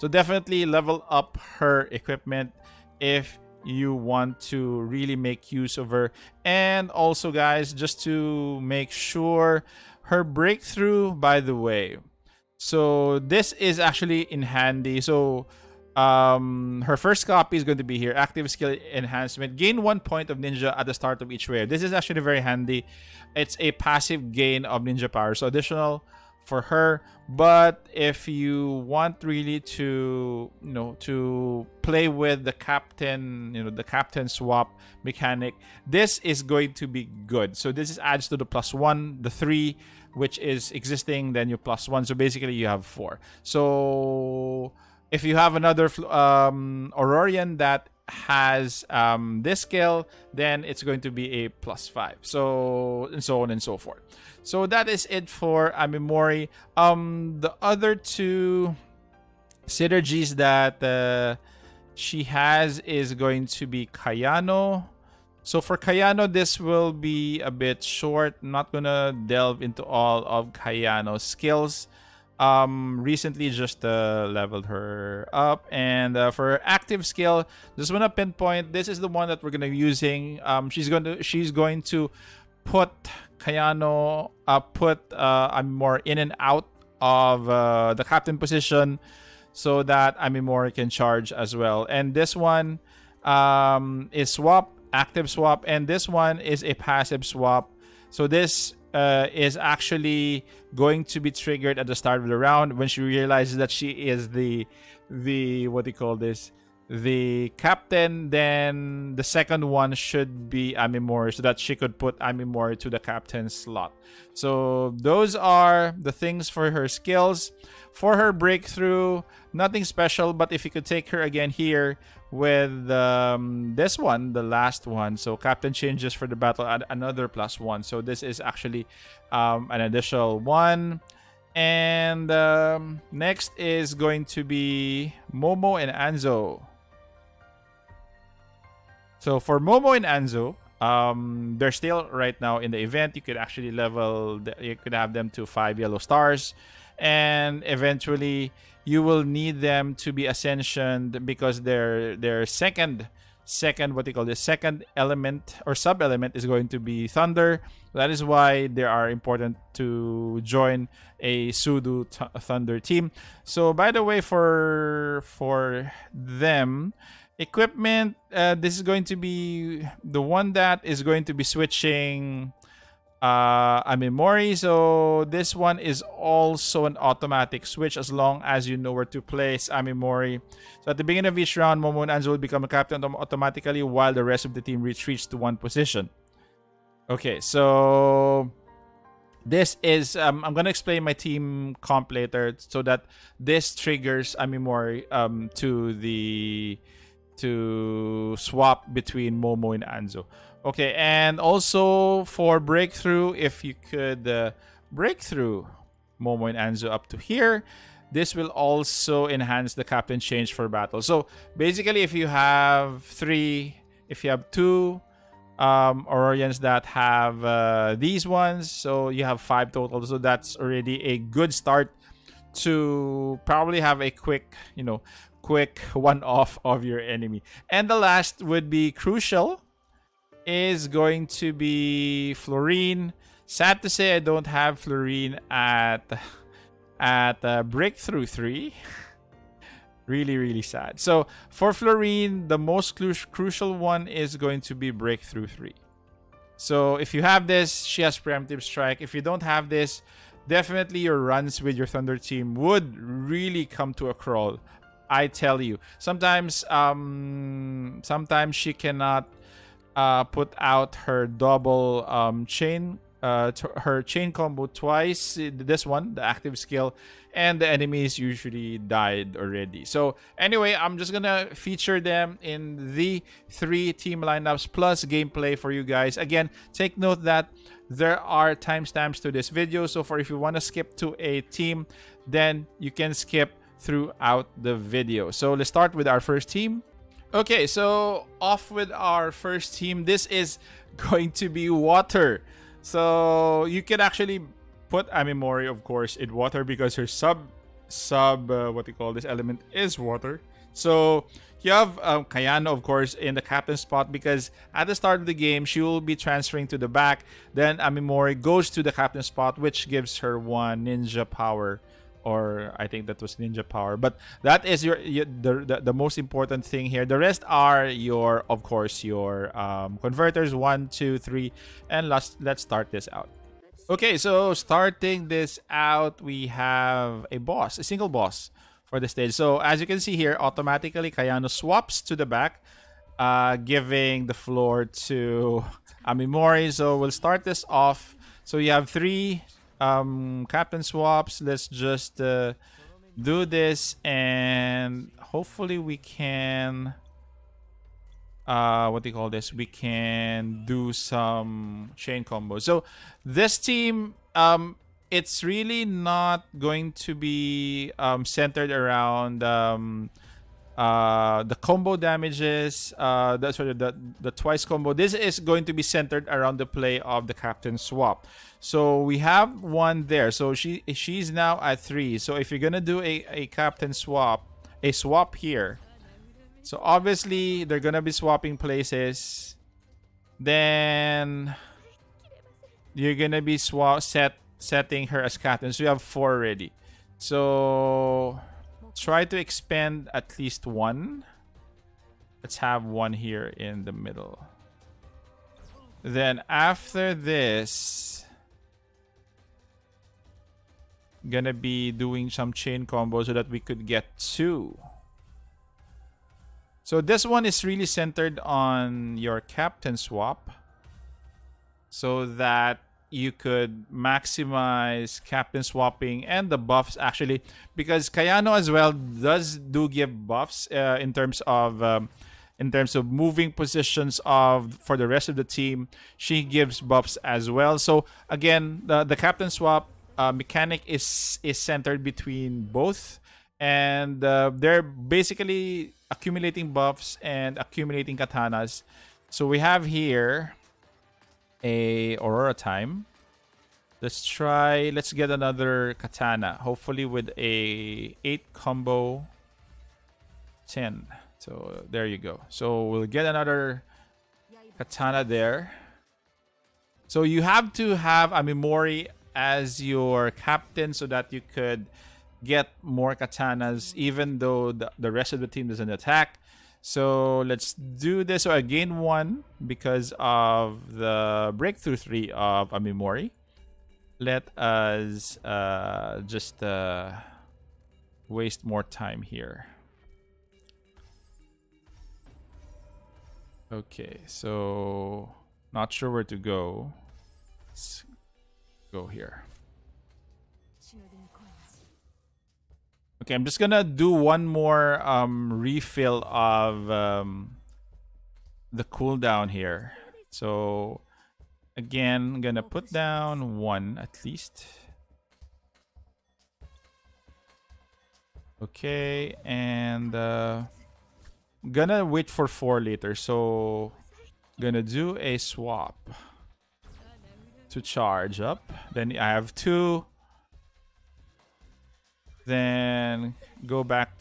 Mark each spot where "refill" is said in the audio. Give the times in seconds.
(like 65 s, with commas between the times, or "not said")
495 s.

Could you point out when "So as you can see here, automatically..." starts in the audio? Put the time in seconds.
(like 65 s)
329 s.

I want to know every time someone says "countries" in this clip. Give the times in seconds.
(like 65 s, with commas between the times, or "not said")
not said.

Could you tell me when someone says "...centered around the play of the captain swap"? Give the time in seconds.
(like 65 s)
365 s.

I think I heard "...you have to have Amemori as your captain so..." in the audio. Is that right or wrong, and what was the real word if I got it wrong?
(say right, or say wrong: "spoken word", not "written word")
right.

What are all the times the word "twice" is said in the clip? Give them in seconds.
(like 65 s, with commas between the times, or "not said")
264 s, 364 s.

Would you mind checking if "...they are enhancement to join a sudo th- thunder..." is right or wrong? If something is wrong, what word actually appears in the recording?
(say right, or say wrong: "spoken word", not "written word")
wrong: "important", not "enhancement".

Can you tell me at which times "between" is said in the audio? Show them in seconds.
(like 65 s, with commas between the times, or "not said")
198 s, 432 s.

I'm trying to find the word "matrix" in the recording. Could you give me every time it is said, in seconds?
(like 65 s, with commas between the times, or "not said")
not said.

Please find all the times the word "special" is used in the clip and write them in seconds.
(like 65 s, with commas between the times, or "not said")
119 s.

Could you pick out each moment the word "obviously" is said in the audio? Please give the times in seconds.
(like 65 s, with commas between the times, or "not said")
376 s.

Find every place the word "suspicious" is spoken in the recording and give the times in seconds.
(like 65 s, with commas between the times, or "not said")
not said.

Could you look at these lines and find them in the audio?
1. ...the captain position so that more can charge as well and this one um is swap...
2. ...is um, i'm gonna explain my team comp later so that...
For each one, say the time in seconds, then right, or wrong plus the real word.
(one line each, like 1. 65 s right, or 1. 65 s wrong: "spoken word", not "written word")
1. 87 s right
2. 189 s right.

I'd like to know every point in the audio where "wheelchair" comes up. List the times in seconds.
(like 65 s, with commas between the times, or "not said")
not said.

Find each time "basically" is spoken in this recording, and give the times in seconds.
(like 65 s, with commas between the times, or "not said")
42 s, 211 s, 434 s.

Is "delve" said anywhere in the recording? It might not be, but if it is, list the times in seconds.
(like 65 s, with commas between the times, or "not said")
69 s.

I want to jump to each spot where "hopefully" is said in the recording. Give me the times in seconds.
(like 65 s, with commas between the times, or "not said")
345 s, 446 s.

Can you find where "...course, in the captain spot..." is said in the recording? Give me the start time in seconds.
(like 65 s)
302 s.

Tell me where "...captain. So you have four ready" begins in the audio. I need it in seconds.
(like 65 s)
385 s.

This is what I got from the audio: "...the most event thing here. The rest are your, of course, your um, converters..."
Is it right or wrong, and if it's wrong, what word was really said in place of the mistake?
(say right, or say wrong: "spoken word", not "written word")
wrong: "important", not "event".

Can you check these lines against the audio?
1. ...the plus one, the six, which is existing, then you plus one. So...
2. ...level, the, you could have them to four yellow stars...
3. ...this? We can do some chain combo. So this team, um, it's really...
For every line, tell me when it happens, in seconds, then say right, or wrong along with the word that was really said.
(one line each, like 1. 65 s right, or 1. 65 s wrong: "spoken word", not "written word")
1. 38 s wrong: "three", not "six"
2. 143 s wrong: "five", not "four"
3. 349 s right.